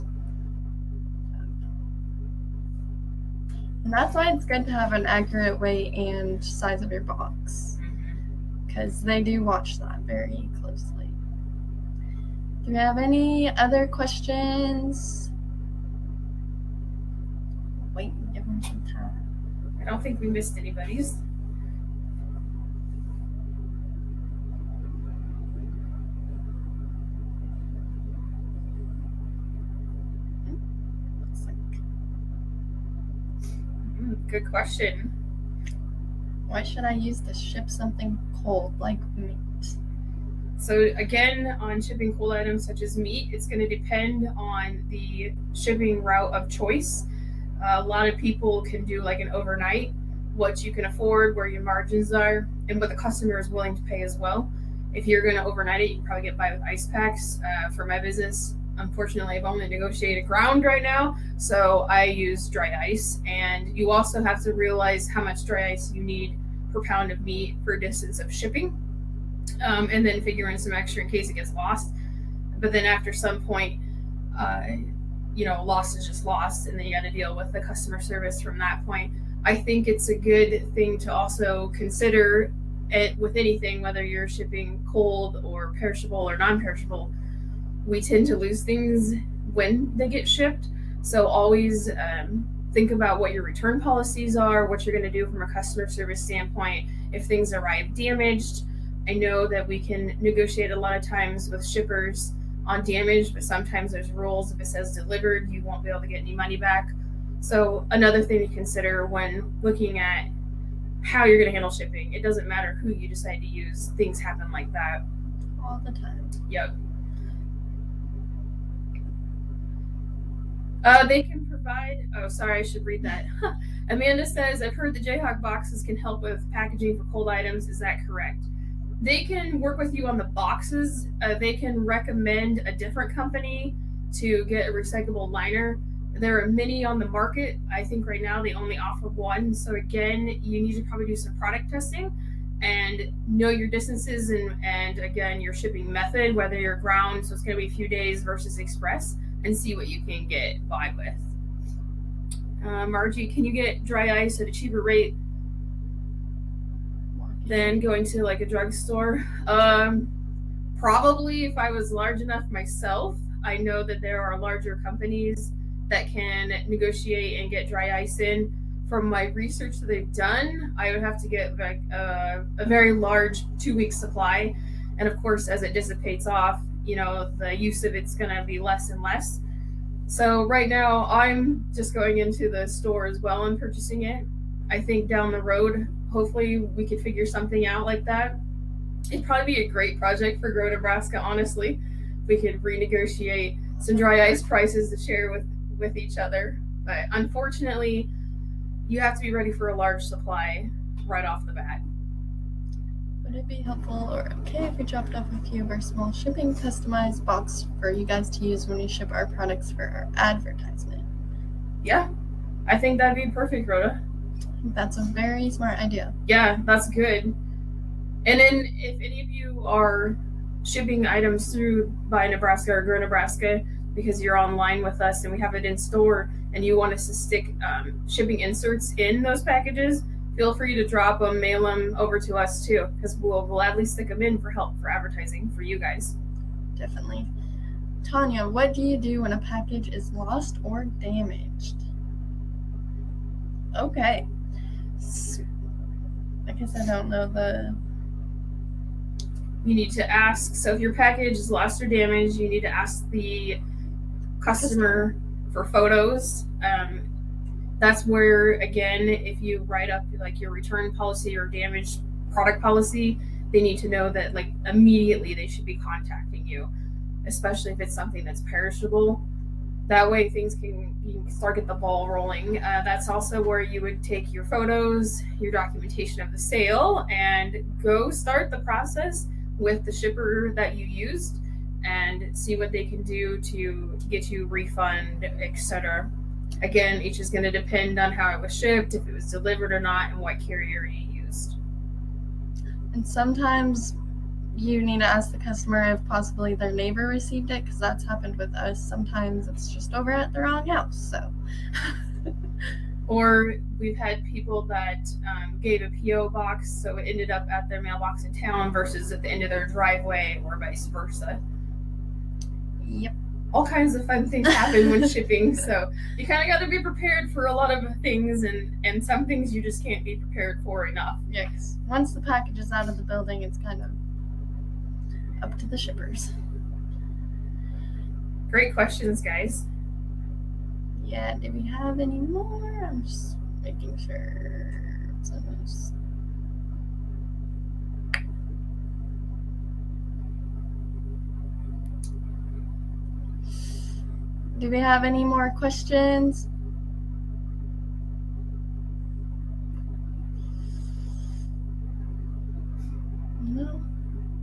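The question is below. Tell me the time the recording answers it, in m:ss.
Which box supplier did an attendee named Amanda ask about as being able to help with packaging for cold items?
2:04.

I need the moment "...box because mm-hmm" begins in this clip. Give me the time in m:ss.
0:07.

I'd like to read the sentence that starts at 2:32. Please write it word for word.
Uh, Margie, can you get dry ice at a cheaper rate than going to like a drugstore?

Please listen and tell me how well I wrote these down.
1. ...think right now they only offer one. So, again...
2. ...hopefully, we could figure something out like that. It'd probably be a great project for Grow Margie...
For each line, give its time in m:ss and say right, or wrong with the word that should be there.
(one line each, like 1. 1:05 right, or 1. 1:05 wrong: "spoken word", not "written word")
1. 2:17 right
2. 3:06 wrong: "Nebraska", not "Margie".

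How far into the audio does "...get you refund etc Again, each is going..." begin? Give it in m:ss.
4:44.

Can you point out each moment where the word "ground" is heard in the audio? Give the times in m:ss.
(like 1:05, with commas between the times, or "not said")
1:00, 2:26.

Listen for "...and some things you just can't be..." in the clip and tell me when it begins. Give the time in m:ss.
5:18.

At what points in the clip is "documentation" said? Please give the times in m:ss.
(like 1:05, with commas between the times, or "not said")
4:35.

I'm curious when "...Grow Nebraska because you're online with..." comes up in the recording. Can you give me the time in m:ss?
3:42.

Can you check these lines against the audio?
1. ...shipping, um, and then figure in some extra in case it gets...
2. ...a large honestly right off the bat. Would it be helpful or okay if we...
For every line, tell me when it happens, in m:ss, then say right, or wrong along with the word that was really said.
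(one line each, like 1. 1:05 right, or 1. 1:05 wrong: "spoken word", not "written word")
1. 1:08 right
2. 3:19 wrong: "supply", not "honestly".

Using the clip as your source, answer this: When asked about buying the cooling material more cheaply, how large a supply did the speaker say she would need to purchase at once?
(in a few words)
two week supply.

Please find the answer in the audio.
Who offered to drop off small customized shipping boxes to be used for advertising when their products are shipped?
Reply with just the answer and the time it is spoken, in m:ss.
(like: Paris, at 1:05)
Rhoda, at 3:33.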